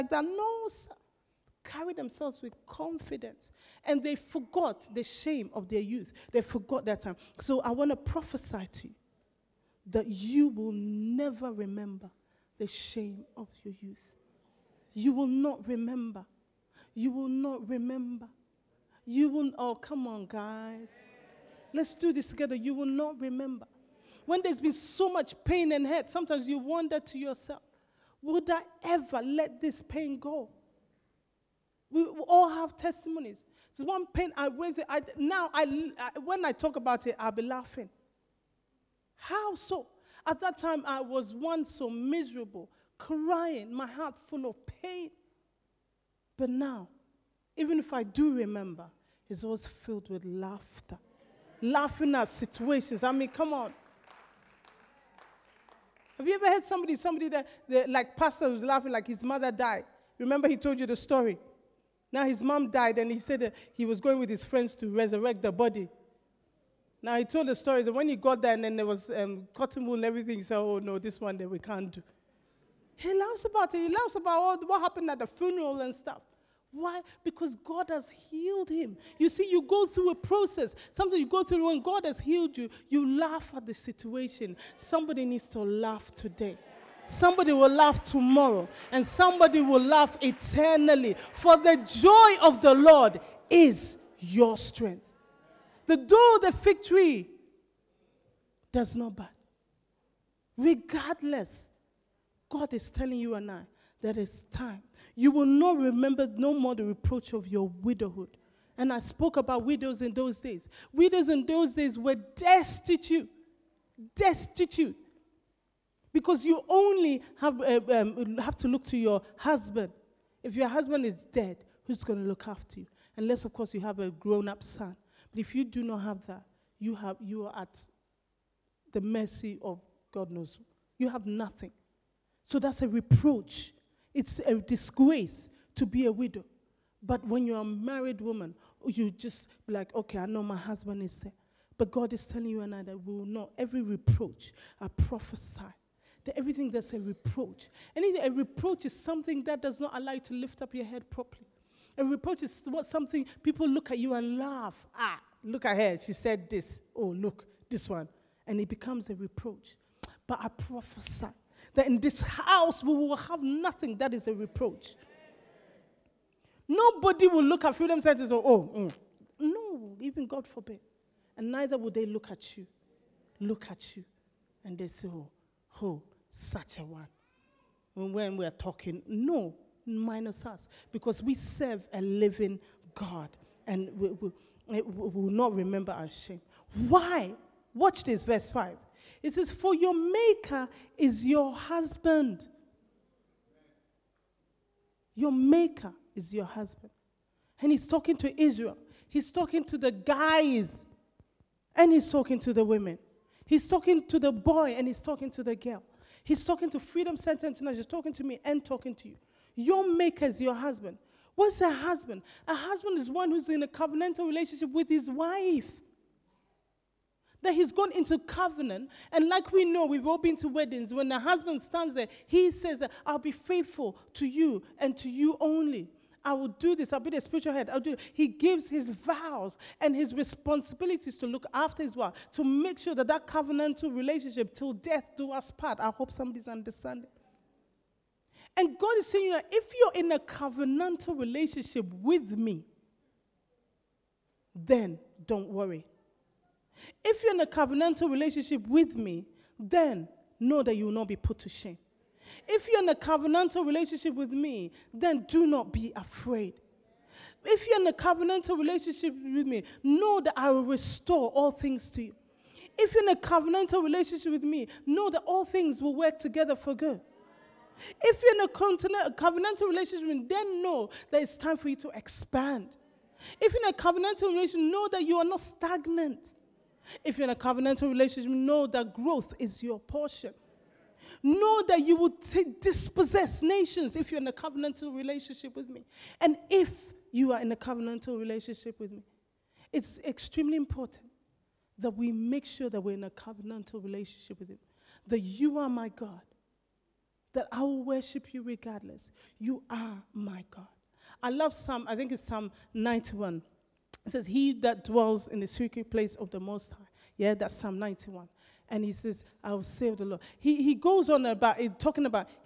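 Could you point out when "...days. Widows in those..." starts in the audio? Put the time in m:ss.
1:50.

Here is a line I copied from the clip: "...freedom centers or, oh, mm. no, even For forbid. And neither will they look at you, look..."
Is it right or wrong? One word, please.
wrong.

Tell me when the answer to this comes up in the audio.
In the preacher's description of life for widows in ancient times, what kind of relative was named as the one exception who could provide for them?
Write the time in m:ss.
2:04.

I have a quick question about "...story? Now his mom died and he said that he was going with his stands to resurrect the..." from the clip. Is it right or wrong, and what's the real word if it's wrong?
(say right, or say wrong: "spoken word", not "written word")
wrong: "friends", not "stands".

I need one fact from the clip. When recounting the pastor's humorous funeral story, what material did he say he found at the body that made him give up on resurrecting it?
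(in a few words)
cotton wool.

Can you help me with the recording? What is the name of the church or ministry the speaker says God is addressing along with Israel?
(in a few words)
Freedom Center International.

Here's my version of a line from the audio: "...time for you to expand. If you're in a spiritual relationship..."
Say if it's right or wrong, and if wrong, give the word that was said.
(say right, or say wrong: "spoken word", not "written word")
wrong: "covenantal", not "spiritual".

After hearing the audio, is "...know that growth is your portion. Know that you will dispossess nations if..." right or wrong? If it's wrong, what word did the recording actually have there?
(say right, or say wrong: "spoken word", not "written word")
right.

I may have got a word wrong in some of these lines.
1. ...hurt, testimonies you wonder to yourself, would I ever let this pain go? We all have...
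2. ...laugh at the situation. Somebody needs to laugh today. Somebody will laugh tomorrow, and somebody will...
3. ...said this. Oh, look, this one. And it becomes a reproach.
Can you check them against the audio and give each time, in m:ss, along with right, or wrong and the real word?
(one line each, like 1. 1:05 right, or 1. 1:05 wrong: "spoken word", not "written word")
1. 0:25 wrong: "sometimes", not "testimonies"
2. 1:23 right
3. 2:36 right.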